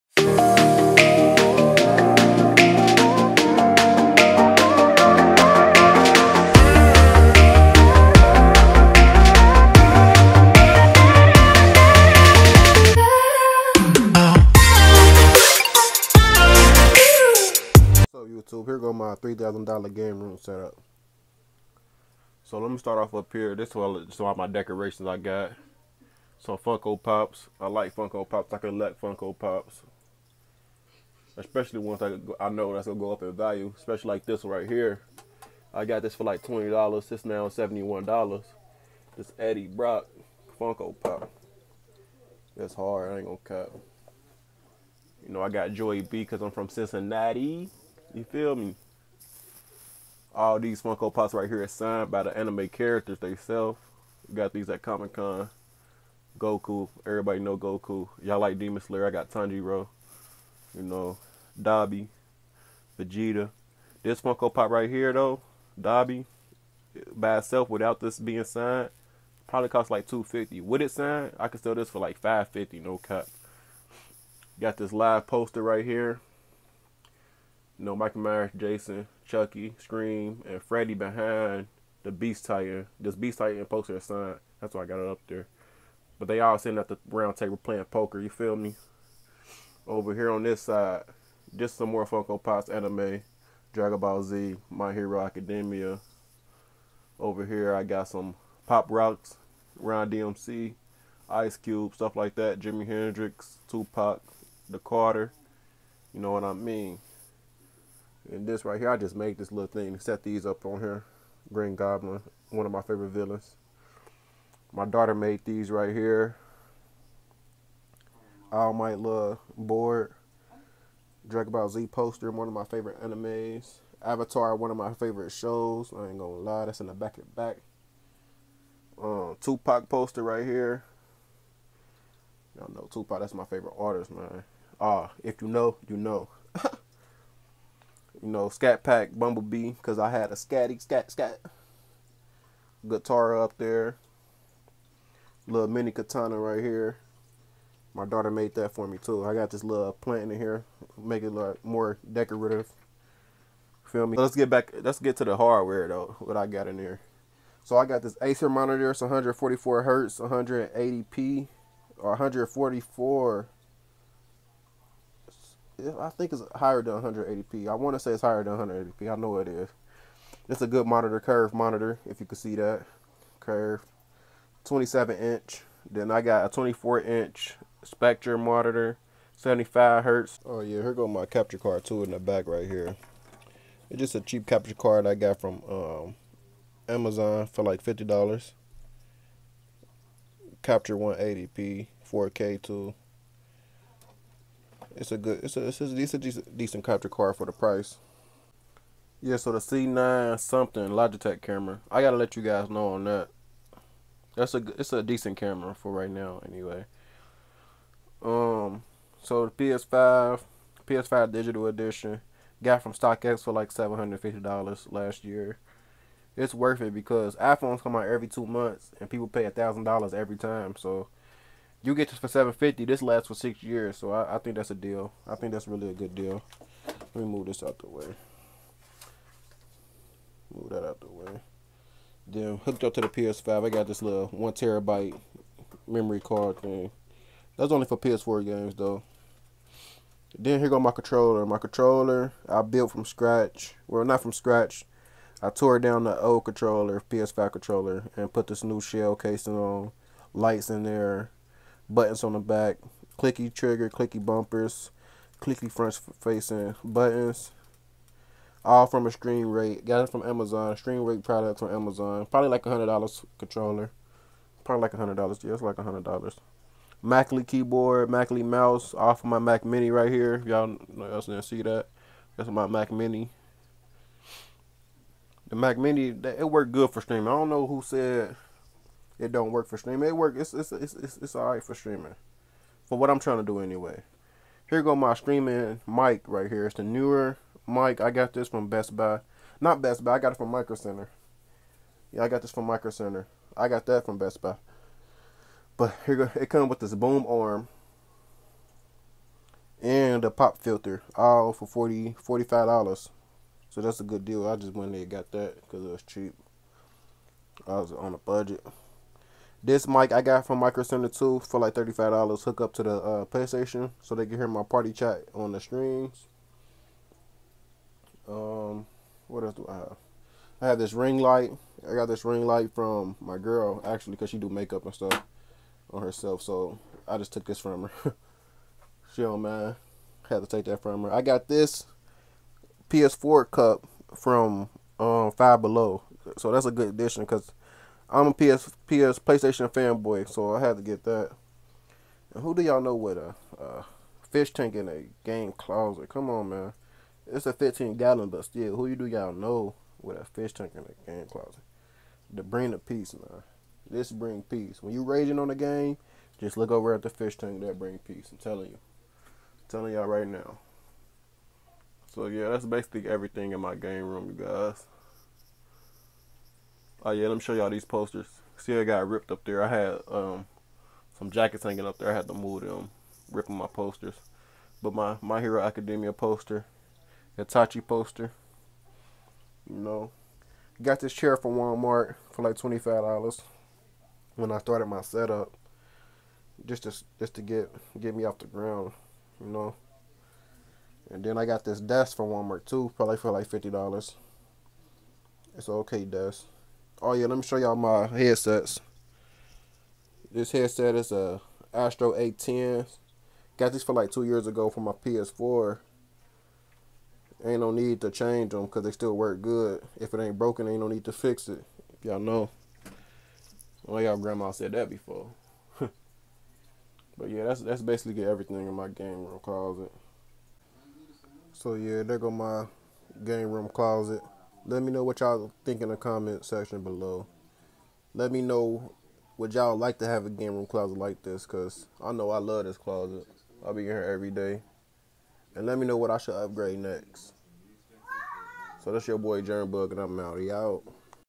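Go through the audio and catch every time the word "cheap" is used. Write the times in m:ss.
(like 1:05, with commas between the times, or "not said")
3:04, 5:06.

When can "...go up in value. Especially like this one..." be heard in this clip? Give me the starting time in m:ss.
0:32.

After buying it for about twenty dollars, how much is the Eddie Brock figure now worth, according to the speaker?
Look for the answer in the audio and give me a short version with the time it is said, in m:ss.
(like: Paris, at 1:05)
$71, at 0:37.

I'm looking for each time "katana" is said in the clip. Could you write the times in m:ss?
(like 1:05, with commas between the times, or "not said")
2:25.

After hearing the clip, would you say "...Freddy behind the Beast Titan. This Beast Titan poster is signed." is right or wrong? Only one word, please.
right.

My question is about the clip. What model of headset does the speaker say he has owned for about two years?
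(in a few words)
Astro A10.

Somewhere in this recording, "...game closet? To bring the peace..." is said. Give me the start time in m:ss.
5:51.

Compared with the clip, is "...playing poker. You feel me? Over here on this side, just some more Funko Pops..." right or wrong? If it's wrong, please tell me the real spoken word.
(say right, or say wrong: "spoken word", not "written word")
right.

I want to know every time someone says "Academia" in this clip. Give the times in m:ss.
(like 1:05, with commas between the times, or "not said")
1:35, 6:15.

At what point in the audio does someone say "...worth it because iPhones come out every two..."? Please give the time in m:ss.
3:36.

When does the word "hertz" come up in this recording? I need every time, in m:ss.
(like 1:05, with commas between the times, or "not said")
2:39, 3:00.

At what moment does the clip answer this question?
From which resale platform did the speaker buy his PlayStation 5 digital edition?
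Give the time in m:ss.
3:32.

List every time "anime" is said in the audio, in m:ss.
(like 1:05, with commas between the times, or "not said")
0:52, 1:32, 2:03.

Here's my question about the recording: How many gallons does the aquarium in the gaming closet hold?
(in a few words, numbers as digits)
15.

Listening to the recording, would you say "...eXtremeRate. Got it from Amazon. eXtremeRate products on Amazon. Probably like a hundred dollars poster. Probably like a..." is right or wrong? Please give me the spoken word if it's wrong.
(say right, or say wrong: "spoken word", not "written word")
wrong: "controller", not "poster".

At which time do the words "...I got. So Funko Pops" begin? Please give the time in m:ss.
0:25.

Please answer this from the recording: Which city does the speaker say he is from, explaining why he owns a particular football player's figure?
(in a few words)
Cincinnati.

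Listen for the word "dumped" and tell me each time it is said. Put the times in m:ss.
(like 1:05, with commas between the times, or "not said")
not said.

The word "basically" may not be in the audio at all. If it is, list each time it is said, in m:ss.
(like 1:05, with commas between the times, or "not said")
6:02, 6:57.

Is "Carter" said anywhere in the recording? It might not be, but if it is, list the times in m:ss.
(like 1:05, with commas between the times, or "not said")
1:44.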